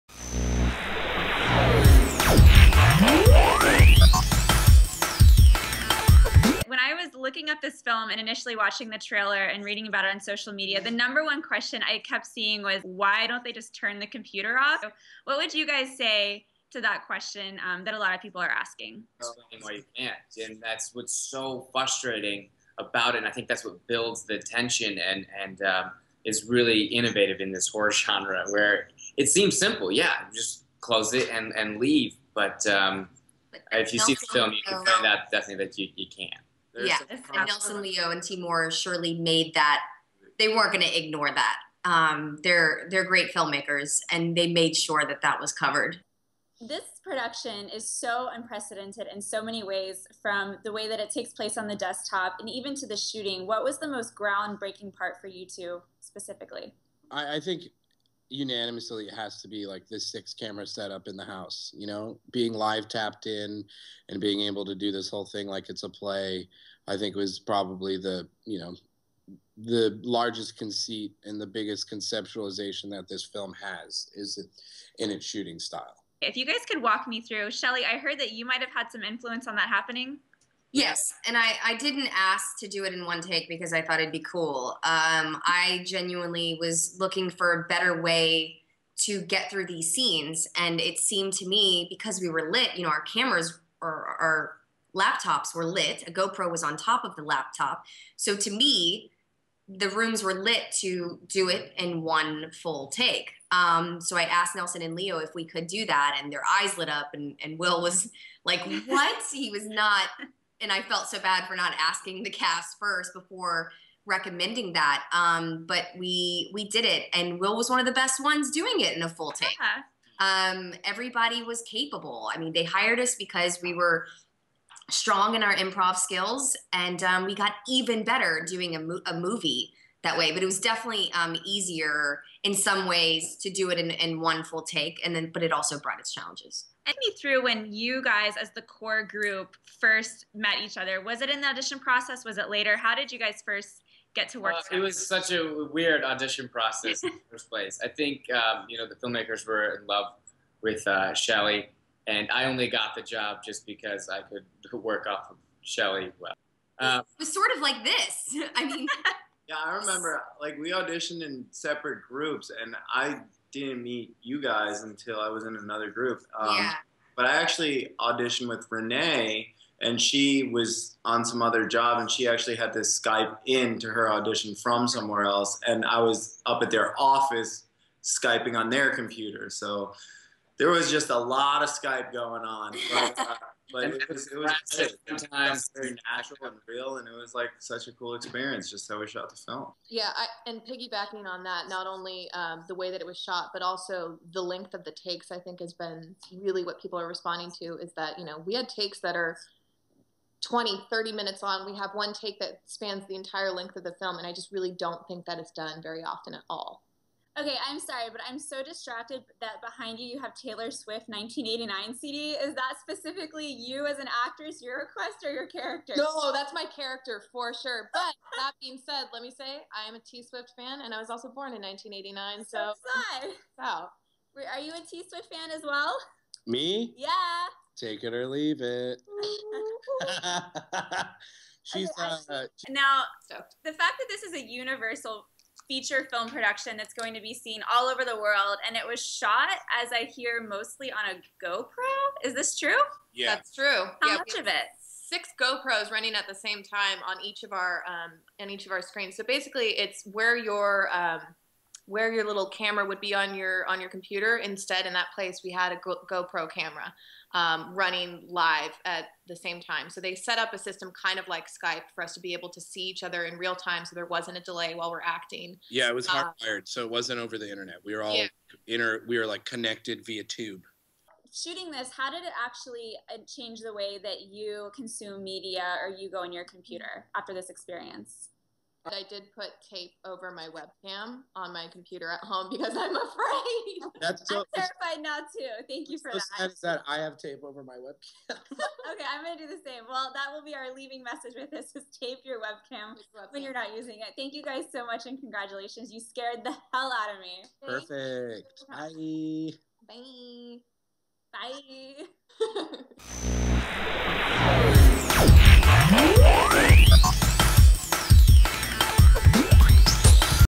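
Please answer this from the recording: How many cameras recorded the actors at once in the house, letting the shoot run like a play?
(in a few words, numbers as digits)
6.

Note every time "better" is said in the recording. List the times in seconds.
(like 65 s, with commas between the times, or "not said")
87 s, 128 s.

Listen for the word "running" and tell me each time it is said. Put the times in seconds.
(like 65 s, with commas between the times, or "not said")
245 s, 257 s.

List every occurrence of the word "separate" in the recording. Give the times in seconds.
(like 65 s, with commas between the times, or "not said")
161 s.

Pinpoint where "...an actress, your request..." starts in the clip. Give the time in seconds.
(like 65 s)
213 s.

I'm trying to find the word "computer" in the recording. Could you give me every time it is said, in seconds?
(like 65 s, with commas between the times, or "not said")
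14 s, 178 s, 253 s, 276 s, 281 s.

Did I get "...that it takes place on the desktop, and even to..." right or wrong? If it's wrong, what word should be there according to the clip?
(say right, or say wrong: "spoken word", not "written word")
right.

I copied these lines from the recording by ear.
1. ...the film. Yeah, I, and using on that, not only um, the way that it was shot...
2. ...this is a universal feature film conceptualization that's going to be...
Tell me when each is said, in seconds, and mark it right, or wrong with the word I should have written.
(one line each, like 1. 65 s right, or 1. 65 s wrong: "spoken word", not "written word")
1. 189 s wrong: "piggybacking", not "using"
2. 234 s wrong: "production", not "conceptualization".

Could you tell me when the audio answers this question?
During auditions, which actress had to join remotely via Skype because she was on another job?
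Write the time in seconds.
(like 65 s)
168 s.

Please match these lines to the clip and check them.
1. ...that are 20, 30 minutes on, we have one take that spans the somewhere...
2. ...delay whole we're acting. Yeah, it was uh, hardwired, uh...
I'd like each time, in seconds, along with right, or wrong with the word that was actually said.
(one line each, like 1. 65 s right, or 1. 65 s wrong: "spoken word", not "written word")
1. 199 s wrong: "entire", not "somewhere"
2. 264 s wrong: "while", not "whole".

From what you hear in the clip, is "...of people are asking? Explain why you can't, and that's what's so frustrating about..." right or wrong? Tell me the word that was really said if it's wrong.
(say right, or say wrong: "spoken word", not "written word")
right.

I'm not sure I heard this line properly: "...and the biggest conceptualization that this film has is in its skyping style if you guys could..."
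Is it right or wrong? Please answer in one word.
wrong.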